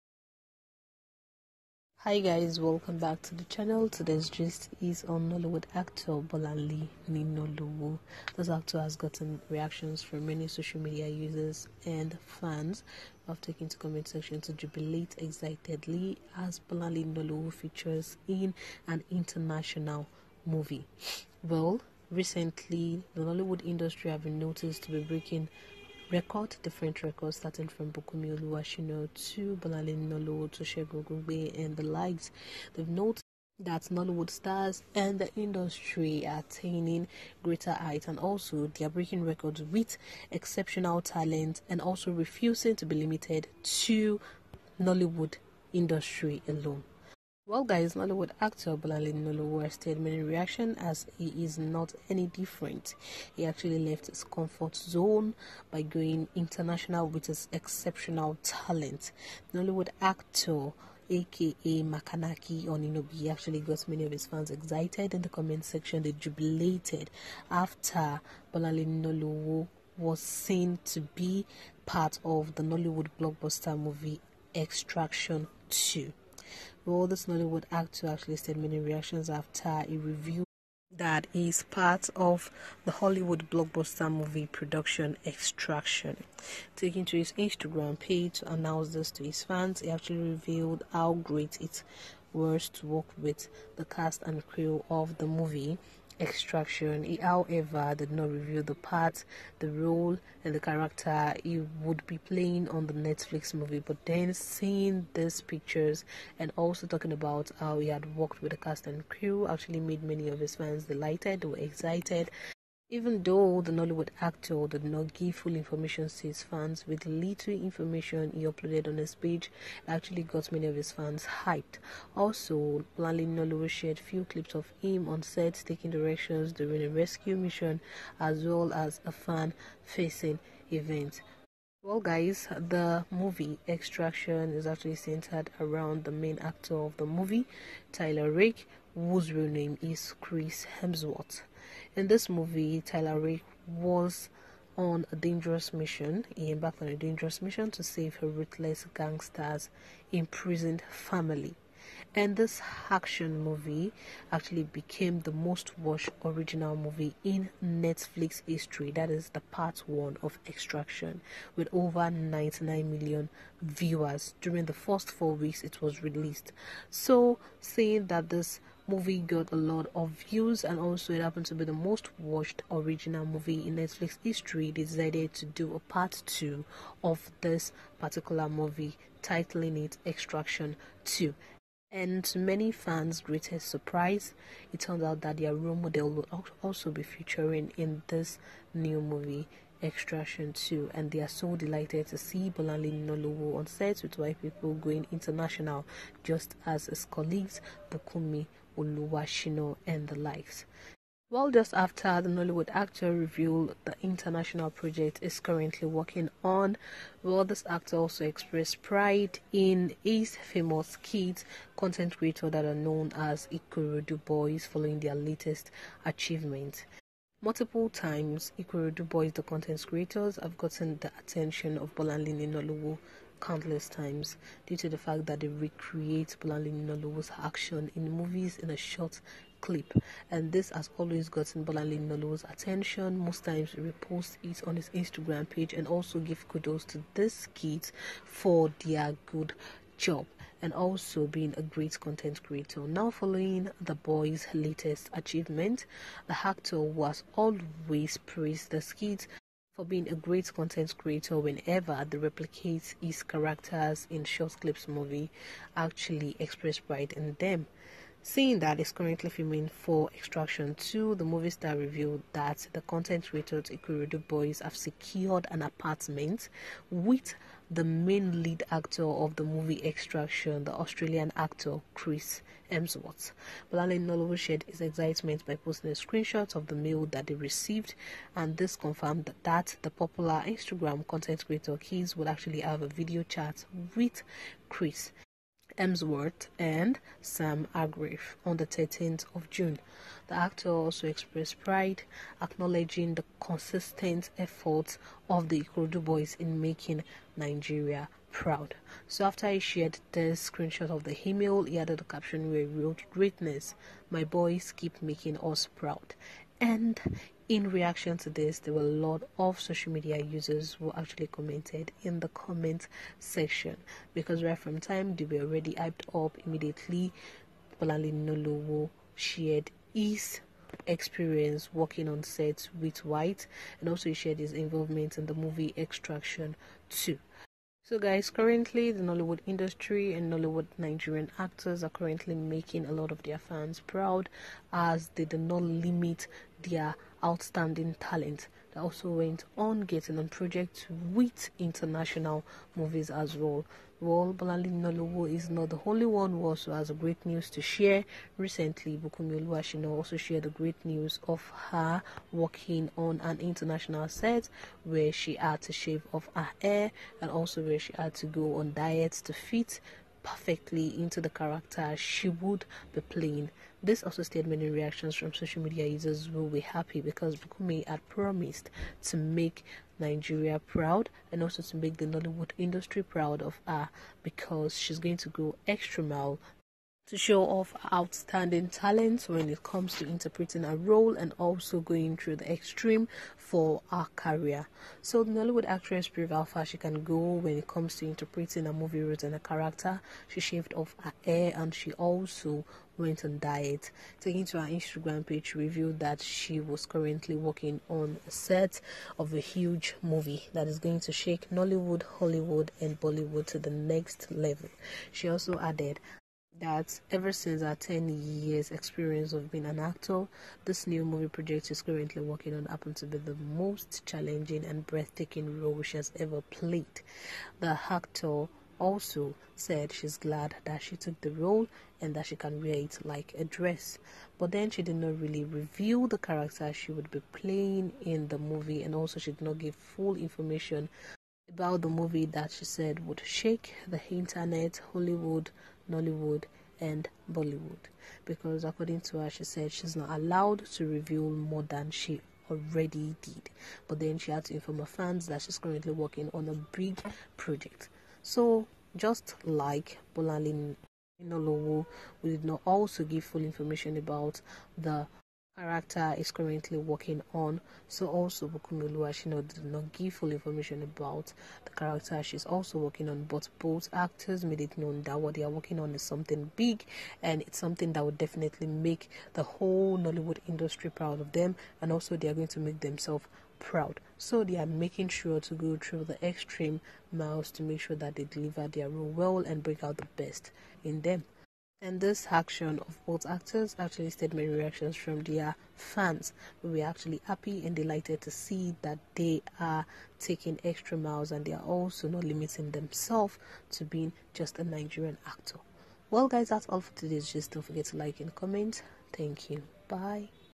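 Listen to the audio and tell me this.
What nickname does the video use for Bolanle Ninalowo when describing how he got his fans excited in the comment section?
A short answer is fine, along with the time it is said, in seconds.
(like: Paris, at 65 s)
Makanaki Oninobi, at 61 s.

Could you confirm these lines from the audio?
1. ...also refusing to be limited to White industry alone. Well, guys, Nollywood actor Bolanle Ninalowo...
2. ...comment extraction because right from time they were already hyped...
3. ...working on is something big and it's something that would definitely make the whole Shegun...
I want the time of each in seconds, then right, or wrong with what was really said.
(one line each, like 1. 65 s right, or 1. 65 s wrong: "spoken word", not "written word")
1. 41 s wrong: "Nollywood", not "White"
2. 312 s wrong: "section", not "extraction"
3. 465 s wrong: "Nollywood", not "Shegun".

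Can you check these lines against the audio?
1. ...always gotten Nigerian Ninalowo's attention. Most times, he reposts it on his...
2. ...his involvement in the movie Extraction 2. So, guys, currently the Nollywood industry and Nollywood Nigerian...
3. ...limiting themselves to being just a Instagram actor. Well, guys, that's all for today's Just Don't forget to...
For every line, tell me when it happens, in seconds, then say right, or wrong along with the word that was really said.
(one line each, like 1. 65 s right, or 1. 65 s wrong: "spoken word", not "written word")
1. 230 s wrong: "Bolanle", not "Nigerian"
2. 324 s right
3. 492 s wrong: "Nigerian", not "Instagram".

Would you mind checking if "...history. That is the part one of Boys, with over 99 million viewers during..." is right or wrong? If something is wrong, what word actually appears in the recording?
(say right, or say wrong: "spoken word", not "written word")
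wrong: "Extraction", not "Boys".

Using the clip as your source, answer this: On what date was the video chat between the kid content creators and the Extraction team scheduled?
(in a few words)
13 June.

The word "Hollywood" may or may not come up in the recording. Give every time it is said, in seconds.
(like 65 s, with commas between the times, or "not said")
82 s, 402 s, 434 s.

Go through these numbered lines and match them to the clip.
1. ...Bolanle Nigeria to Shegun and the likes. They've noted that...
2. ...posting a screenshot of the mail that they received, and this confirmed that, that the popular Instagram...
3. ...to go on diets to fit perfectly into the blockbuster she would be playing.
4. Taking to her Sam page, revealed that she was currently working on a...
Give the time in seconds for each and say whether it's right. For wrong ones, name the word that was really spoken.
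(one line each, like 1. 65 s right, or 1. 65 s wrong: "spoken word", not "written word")
1. 29 s wrong: "Ninalowo", not "Nigeria"
2. 275 s right
3. 358 s wrong: "character", not "blockbuster"
4. 394 s wrong: "Instagram", not "Sam".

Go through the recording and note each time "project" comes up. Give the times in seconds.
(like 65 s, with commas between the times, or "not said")
204 s, 340 s, 411 s, 447 s.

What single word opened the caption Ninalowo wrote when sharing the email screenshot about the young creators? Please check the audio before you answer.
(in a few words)
Greatness.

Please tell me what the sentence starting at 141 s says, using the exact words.
In this movie, Tyler Rick was on a dangerous mission.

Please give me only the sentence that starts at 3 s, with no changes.
Today's gist is on Nollywood actor Bolanle Ninalowo.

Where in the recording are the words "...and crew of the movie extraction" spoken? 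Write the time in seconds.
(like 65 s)
94 s.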